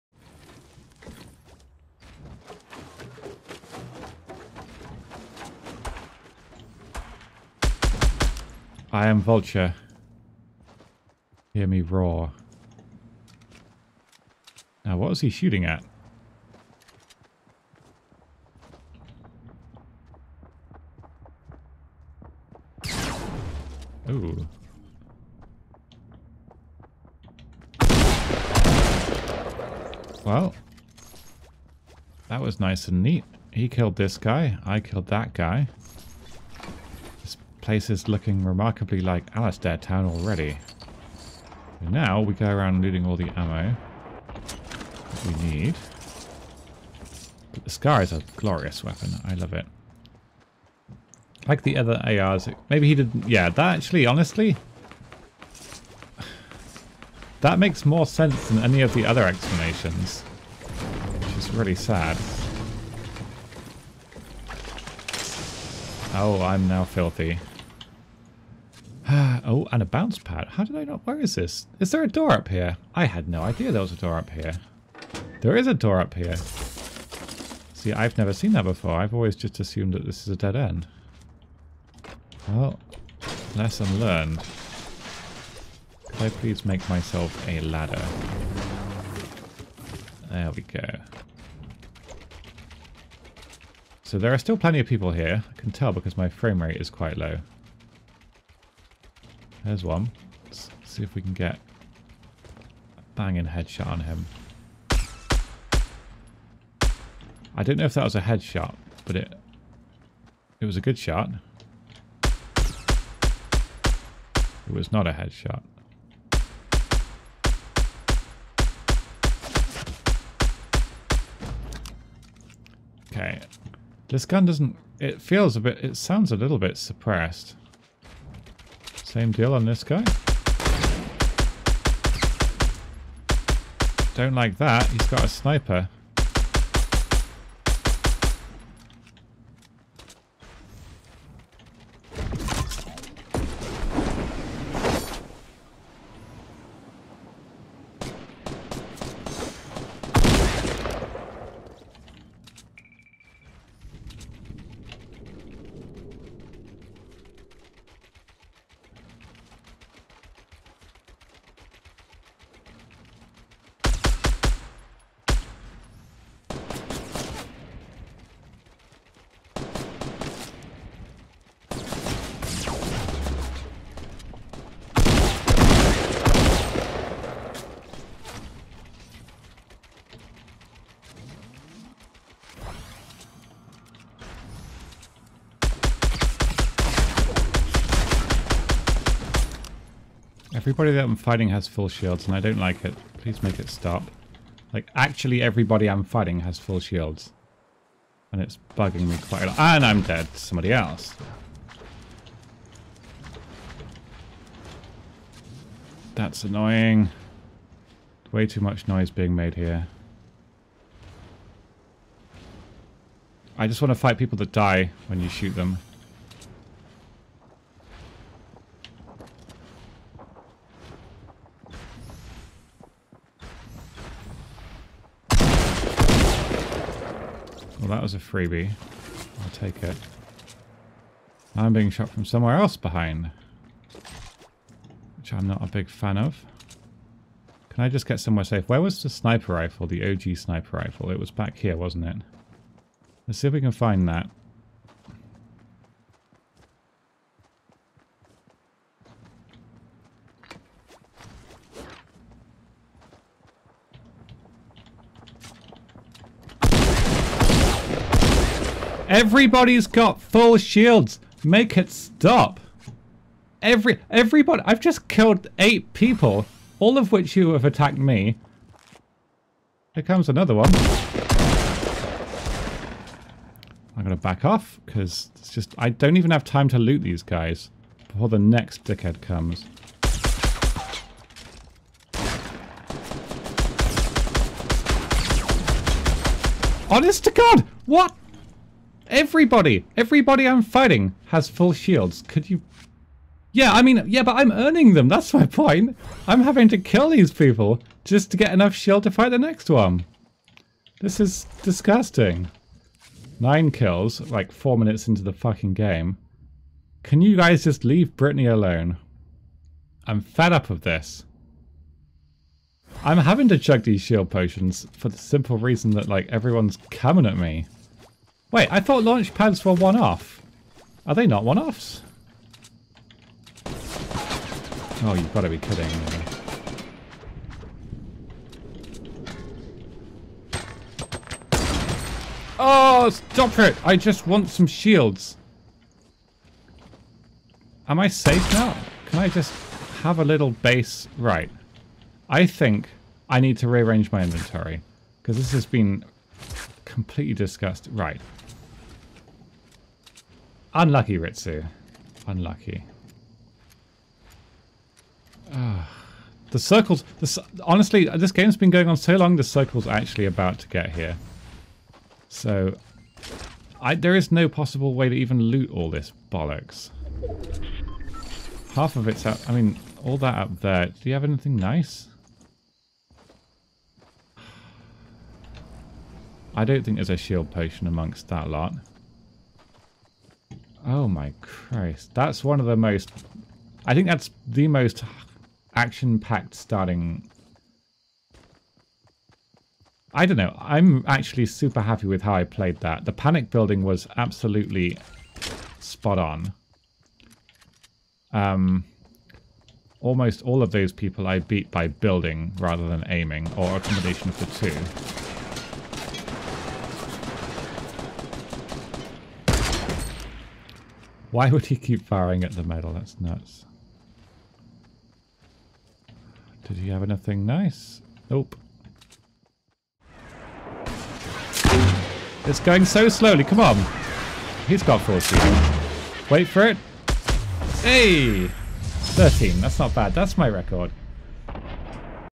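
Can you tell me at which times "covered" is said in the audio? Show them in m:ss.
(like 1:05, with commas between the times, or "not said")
not said.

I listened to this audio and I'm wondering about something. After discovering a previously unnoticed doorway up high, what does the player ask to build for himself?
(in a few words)
A ladder.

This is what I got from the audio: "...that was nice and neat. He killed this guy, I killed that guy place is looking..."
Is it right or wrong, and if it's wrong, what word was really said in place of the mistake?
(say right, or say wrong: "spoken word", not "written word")
right.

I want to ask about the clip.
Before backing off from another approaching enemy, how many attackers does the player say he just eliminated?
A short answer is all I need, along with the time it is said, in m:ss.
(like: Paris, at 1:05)
8, at 4:25.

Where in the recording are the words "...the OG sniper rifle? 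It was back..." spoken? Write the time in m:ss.
3:59.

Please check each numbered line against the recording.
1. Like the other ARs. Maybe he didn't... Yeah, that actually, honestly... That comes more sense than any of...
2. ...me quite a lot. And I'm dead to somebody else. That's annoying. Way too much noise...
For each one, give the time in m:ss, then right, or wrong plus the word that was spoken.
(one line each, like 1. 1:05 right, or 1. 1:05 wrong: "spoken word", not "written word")
1. 0:51 wrong: "makes", not "comes"
2. 3:19 right.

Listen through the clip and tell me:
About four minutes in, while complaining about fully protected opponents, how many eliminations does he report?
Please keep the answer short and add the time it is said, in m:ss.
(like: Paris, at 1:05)
9, at 5:03.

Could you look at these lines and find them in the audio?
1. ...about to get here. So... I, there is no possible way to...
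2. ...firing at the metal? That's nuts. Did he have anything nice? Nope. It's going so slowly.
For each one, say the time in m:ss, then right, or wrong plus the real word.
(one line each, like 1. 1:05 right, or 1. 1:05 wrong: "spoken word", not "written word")
1. 6:00 right
2. 6:52 right.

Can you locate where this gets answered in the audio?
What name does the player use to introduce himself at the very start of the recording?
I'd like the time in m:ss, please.
0:08.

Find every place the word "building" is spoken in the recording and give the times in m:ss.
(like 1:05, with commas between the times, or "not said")
6:33, 6:41.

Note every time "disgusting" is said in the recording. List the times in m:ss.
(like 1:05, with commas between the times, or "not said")
5:01, 5:47.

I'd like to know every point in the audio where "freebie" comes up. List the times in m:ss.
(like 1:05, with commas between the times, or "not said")
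3:48.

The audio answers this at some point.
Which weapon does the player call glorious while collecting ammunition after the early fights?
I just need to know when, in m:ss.
0:47.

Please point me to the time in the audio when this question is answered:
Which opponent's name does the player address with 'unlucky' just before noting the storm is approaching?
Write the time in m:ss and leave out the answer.
5:51.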